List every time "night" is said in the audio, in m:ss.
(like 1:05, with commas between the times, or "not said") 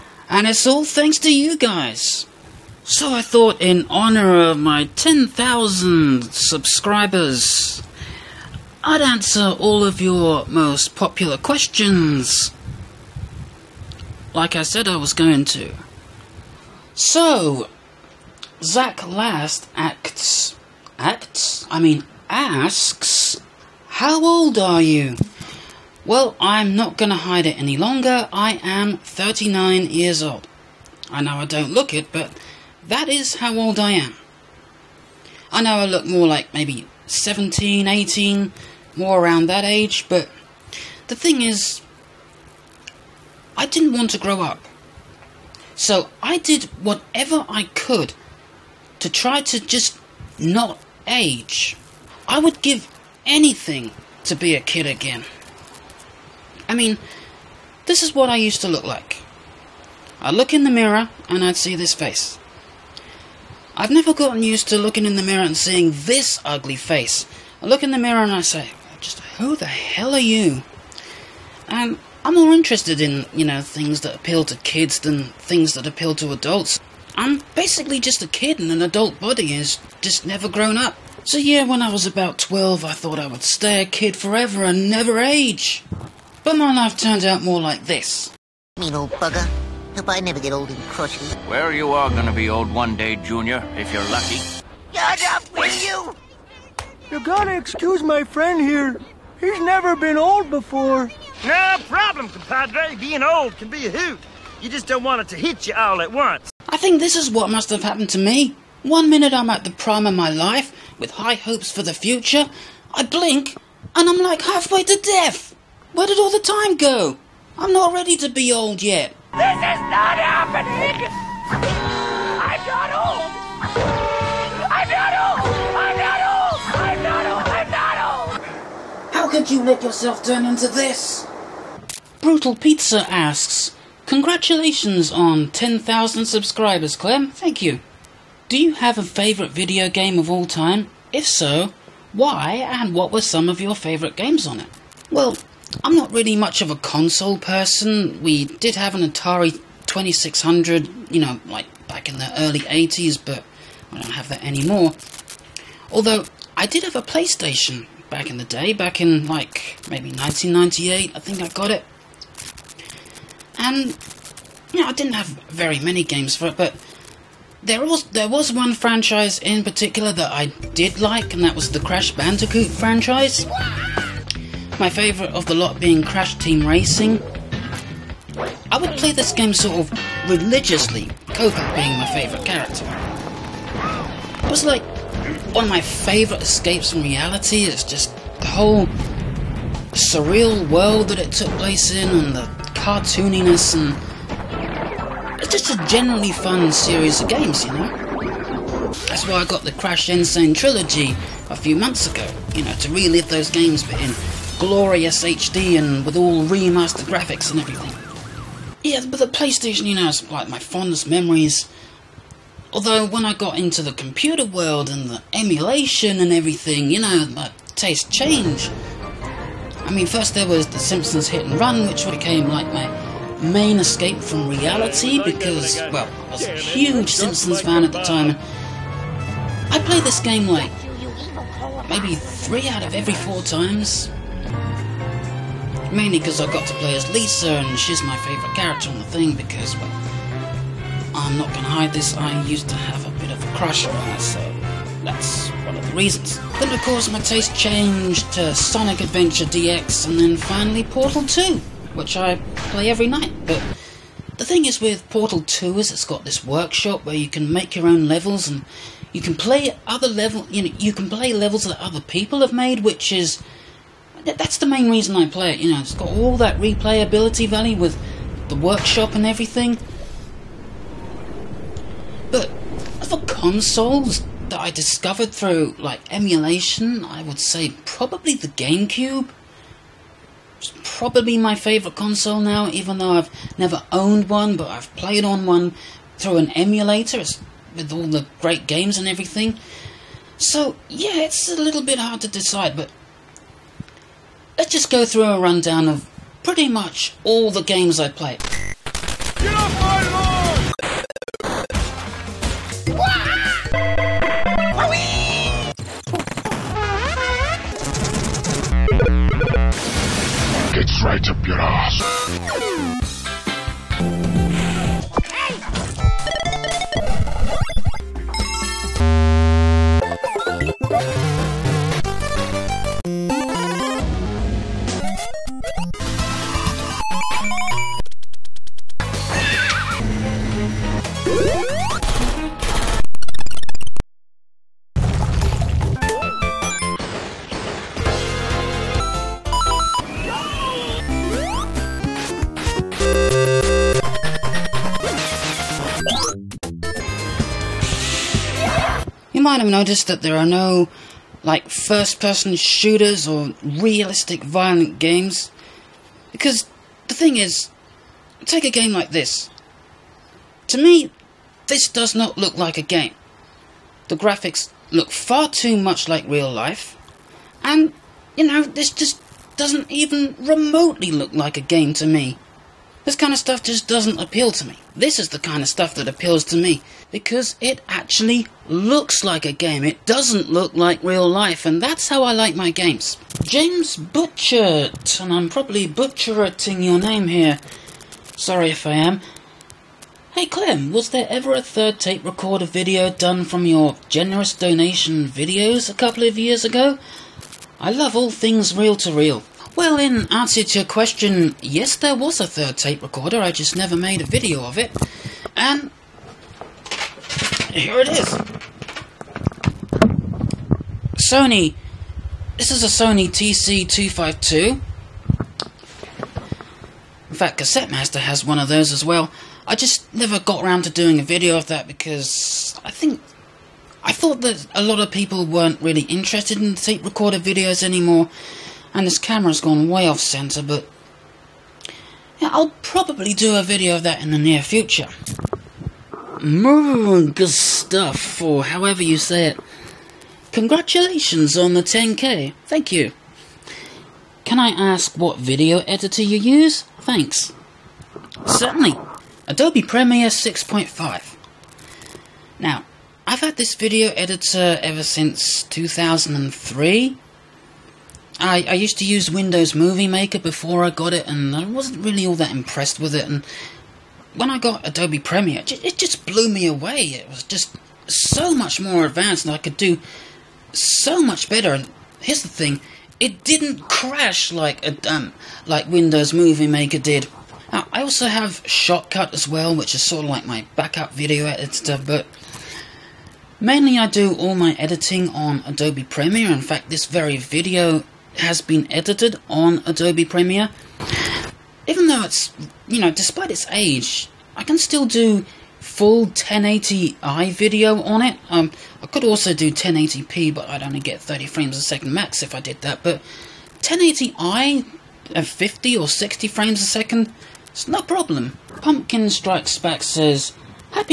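4:13.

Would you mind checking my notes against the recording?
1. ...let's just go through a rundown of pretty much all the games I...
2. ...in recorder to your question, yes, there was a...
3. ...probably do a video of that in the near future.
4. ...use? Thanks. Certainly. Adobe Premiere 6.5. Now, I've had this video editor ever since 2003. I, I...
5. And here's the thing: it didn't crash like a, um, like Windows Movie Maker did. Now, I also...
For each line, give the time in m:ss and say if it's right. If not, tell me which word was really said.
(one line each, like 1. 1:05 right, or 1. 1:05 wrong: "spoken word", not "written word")
1. 4:54 right
2. 6:39 wrong: "answer", not "recorder"
3. 7:12 right
4. 7:26 right
5. 7:51 right.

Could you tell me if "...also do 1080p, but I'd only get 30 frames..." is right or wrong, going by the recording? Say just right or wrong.
right.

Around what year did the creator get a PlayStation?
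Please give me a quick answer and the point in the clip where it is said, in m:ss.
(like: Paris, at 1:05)
1998, at 2:40.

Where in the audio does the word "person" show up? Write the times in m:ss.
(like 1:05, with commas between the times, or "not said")
2:27, 5:51.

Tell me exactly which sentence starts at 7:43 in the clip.
And when I got Adobe Premiere, it just blew me away.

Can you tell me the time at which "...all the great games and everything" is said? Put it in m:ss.
4:47.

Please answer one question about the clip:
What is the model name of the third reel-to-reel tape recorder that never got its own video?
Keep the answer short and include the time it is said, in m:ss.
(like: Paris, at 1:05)
Sony TC252, at 6:53.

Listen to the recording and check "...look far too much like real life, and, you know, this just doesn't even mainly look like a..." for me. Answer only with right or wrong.
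wrong.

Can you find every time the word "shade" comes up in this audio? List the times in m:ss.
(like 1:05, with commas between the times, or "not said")
not said.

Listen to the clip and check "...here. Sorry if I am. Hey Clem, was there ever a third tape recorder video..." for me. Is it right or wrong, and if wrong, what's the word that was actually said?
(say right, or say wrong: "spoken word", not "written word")
right.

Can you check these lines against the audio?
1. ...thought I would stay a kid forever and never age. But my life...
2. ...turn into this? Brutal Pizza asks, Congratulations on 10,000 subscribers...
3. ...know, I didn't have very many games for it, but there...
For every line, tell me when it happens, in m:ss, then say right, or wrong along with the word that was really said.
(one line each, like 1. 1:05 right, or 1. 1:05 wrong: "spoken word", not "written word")
1. 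1:22 right
2. 2:10 right
3. 2:44 right.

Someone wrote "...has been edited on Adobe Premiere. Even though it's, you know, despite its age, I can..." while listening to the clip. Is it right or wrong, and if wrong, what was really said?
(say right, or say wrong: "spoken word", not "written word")
right.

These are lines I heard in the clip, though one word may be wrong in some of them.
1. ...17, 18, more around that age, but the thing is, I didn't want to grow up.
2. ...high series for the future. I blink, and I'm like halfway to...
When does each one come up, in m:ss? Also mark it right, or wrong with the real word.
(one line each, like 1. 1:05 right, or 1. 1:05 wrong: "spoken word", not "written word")
1. 0:37 right
2. 1:51 wrong: "hopes", not "series".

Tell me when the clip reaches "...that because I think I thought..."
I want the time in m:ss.
7:01.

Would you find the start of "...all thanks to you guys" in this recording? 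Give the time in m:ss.
0:00.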